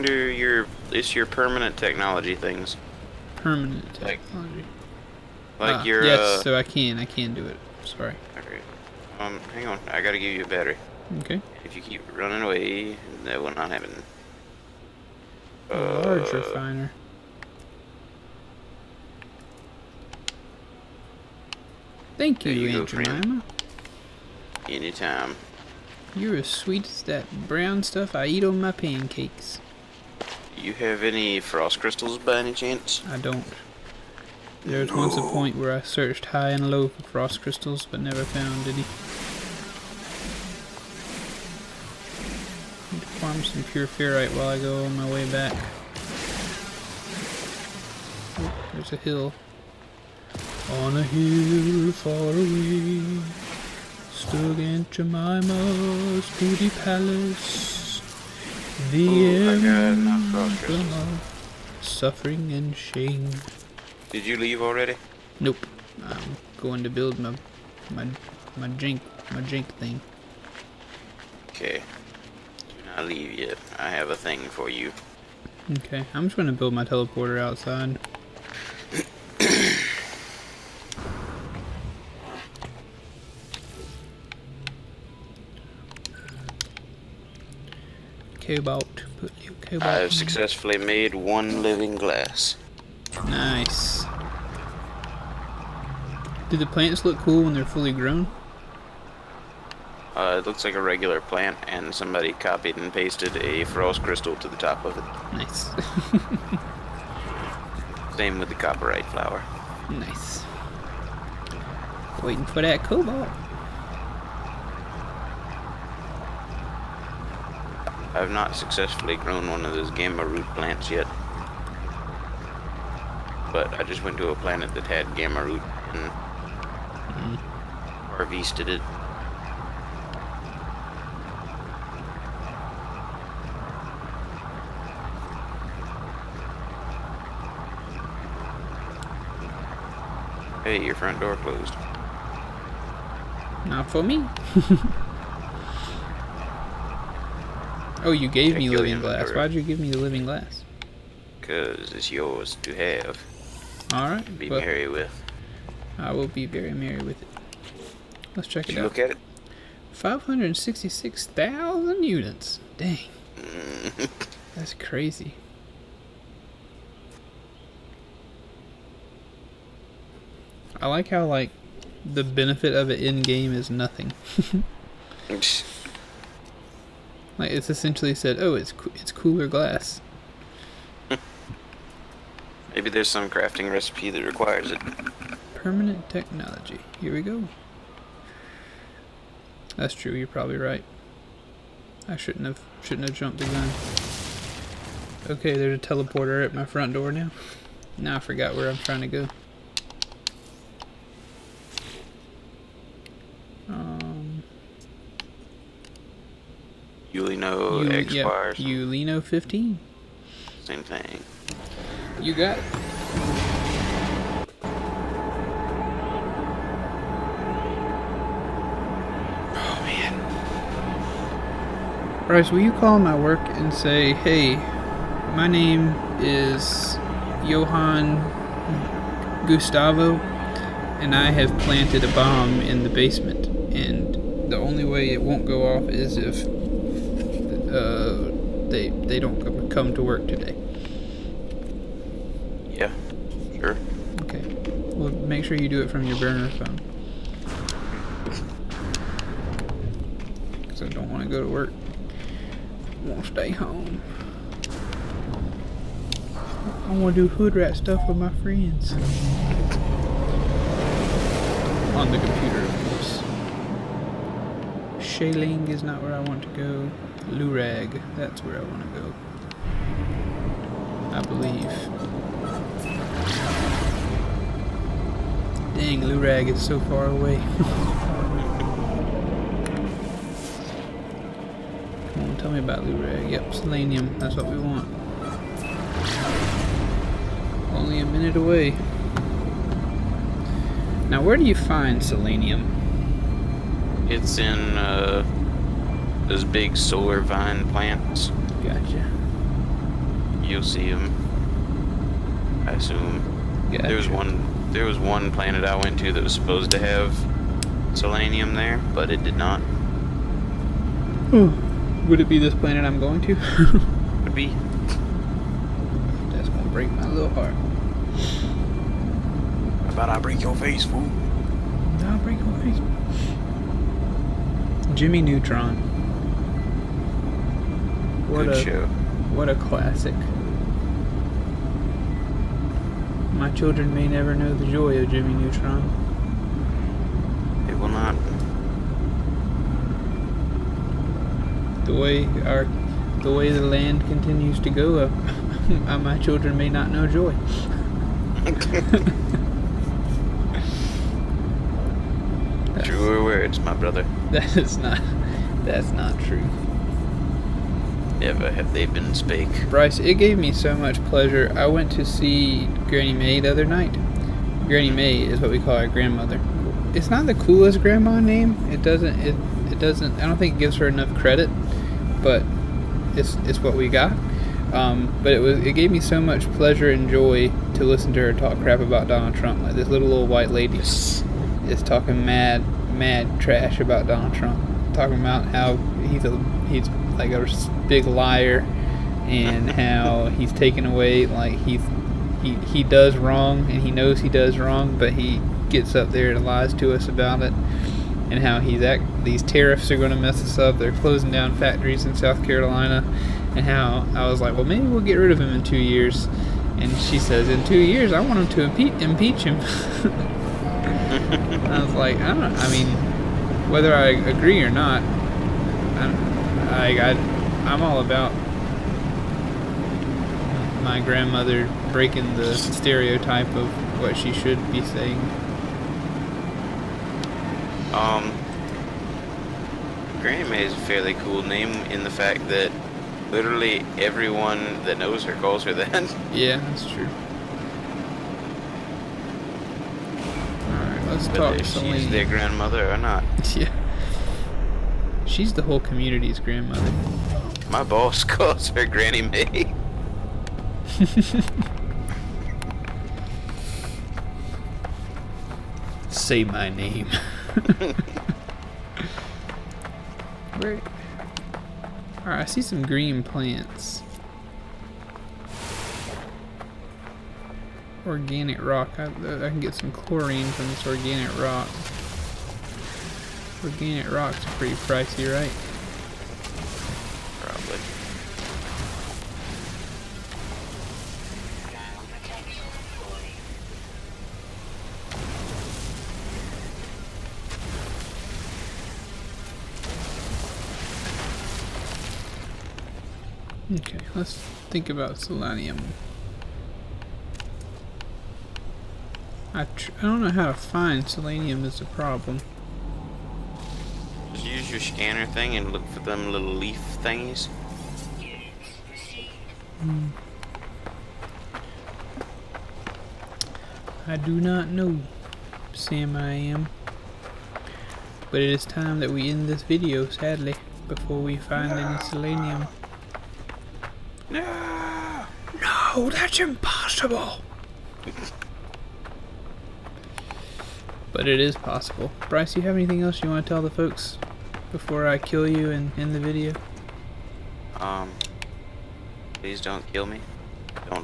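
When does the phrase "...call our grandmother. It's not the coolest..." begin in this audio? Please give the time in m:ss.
6:05.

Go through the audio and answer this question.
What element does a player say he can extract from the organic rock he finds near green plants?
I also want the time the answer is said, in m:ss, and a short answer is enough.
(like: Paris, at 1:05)
Chlorine, at 7:49.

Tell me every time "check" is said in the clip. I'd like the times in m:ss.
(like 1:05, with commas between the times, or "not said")
2:28, 2:38.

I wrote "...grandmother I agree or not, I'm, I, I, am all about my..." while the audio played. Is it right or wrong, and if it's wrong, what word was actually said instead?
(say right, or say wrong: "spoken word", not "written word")
wrong: "whether", not "grandmother".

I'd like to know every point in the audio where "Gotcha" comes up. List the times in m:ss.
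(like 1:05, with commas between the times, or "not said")
4:58, 5:03.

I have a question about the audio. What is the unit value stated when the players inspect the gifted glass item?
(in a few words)
566,000 units.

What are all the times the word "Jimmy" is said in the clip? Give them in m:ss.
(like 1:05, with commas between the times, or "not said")
5:24, 5:35.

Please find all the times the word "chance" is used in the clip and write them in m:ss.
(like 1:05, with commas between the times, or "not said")
0:32.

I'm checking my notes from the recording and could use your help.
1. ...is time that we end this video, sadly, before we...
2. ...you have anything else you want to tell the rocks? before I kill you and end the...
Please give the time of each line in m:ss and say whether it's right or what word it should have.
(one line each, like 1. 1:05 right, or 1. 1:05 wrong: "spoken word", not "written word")
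1. 8:38 right
2. 8:52 wrong: "folks", not "rocks".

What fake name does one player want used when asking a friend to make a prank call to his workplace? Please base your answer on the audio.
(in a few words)
Johann Gustavo.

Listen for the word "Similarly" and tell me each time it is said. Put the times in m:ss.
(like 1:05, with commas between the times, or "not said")
not said.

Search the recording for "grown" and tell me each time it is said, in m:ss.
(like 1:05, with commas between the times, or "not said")
1:37, 1:59.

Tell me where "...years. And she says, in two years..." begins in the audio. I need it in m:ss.
6:45.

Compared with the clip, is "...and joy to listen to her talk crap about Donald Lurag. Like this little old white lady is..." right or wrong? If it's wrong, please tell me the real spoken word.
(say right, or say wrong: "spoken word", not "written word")
wrong: "Trump", not "Lurag".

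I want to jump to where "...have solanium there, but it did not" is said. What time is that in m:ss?
5:06.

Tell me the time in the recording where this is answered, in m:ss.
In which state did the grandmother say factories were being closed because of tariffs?
6:42.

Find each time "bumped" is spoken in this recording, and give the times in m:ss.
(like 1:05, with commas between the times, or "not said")
not said.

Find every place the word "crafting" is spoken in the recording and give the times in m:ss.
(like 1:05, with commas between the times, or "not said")
3:03.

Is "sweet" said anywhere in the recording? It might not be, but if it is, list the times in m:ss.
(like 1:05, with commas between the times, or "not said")
0:26.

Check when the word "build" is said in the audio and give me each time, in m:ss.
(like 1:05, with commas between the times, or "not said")
1:06, 1:16.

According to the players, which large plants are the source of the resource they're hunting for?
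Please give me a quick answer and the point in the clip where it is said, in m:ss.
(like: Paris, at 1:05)
Solar vine plants, at 4:56.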